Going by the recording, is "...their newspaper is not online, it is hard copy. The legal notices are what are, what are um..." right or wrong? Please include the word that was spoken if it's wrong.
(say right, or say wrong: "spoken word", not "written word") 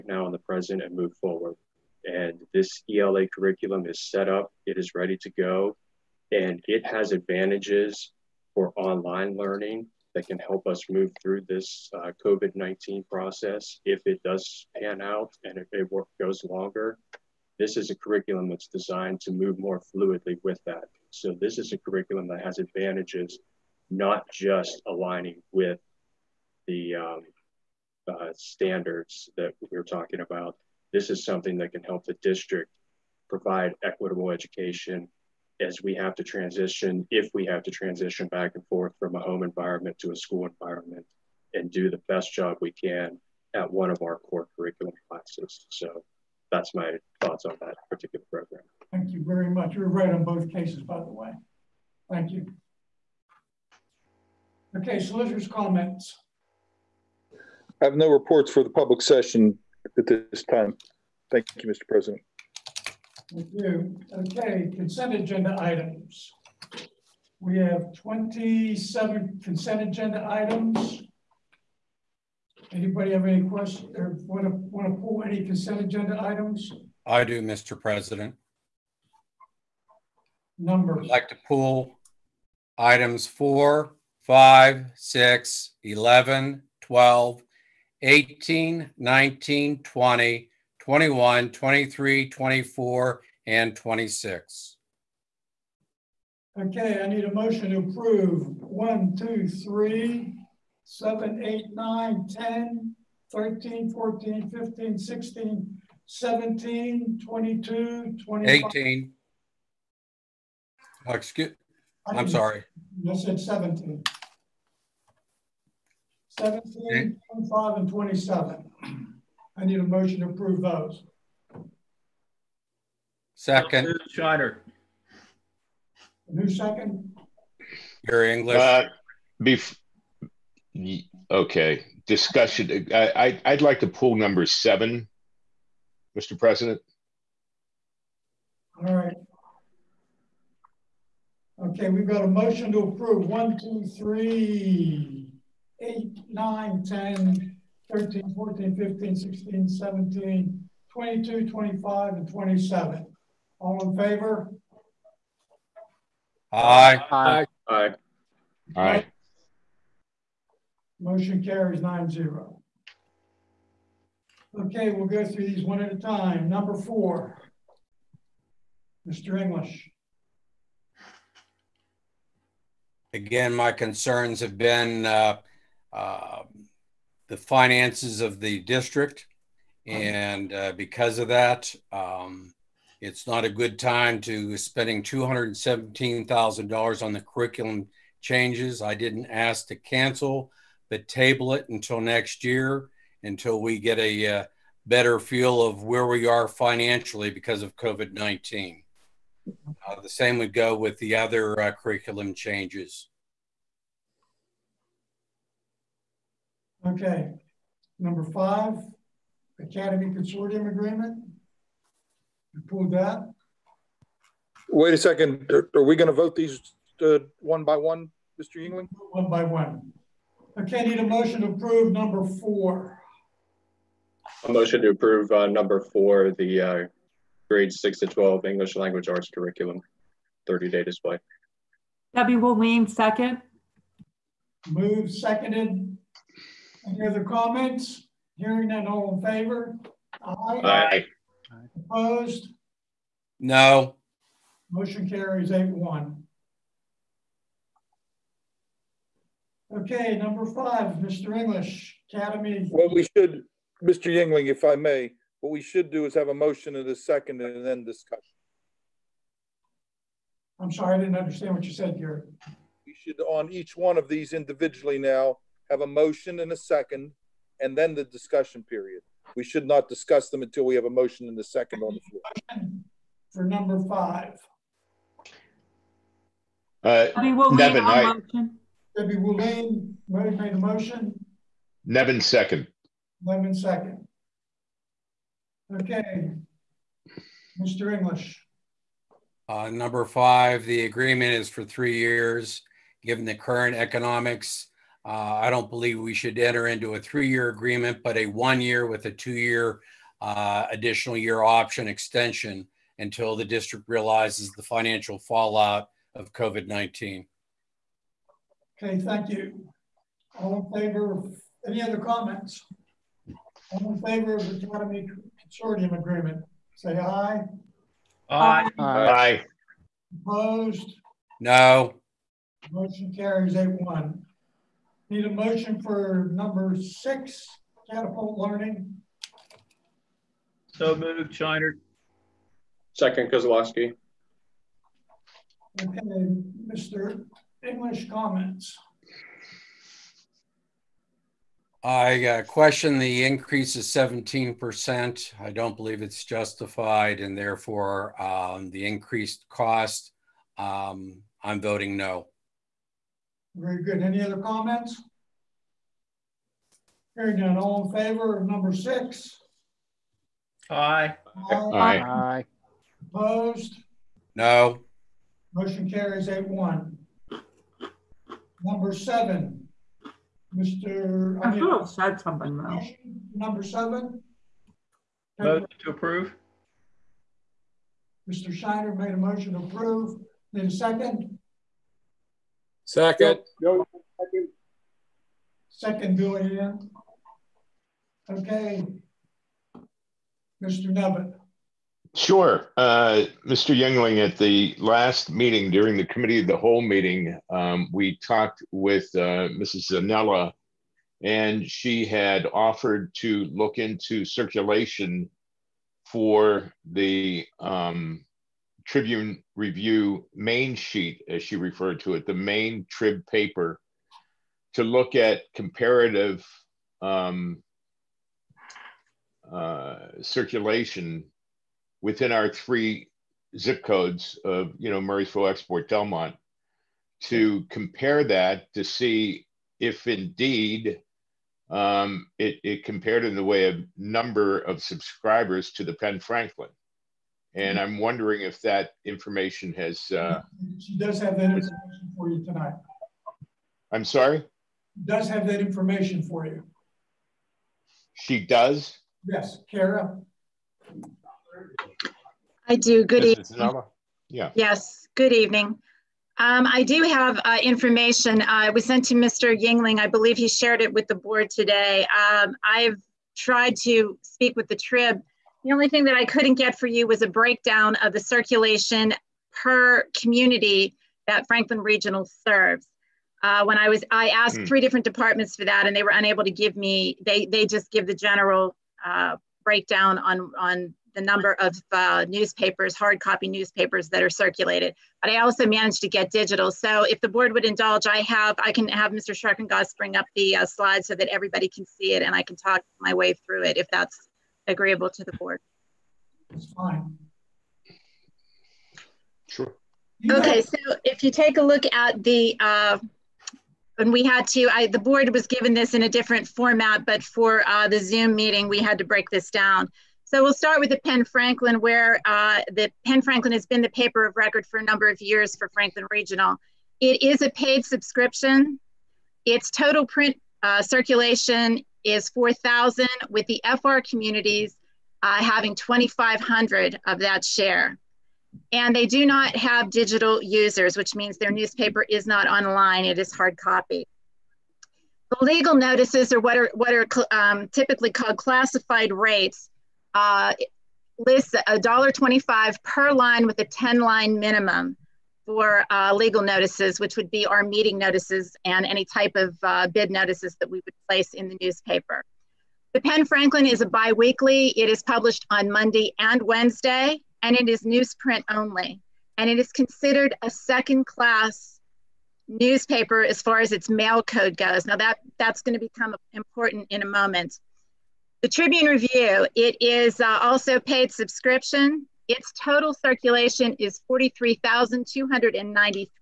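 right.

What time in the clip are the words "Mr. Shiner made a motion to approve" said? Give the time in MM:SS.
06:18.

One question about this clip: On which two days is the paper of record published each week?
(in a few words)
Monday and Wednesday.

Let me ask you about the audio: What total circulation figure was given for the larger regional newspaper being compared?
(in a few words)
43,293.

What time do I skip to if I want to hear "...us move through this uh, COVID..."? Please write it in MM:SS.
00:10.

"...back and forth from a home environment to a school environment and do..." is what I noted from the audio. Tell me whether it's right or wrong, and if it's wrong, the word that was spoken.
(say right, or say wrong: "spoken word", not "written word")
right.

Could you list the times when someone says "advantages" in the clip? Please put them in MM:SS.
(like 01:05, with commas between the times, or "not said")
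00:07, 00:22.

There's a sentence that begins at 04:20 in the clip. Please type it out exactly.
I'm sorry, I didn't understand what you said here.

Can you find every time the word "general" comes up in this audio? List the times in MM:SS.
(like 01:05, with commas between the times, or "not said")
07:58.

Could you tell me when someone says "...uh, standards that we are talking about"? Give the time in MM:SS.
00:28.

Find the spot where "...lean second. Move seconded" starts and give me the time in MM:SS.
03:52.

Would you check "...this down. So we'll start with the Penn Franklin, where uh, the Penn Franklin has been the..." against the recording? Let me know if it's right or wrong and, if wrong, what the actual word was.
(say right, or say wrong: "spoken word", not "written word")
right.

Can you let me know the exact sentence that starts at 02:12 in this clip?
I, I, would like to pull number seven, Mr.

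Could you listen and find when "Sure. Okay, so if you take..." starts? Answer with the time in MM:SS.
08:19.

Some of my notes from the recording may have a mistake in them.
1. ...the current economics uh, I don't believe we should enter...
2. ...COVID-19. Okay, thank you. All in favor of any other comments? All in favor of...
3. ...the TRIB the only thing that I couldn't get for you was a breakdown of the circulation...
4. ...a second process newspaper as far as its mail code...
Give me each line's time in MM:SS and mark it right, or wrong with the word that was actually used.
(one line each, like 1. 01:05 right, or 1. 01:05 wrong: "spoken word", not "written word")
1. 04:53 right
2. 05:06 right
3. 07:44 right
4. 09:20 wrong: "class", not "process".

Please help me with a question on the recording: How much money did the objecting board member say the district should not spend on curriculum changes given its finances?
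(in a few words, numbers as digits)
$217,000.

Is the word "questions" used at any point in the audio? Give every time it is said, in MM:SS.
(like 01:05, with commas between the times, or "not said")
01:13, 05:42.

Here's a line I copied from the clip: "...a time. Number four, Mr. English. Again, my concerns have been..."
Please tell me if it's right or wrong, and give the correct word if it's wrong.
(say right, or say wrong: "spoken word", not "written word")
right.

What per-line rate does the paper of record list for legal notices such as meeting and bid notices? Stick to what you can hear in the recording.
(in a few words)
$1.25.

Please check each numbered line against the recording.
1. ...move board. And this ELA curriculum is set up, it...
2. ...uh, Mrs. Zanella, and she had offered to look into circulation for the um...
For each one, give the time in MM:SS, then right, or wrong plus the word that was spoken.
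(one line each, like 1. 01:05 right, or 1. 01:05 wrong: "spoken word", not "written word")
1. 00:00 wrong: "forward", not "board"
2. 06:39 right.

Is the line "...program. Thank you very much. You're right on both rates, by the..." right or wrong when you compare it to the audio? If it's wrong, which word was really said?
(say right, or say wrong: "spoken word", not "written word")
wrong: "cases", not "rates".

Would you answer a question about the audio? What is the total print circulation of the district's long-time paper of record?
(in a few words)
4,000.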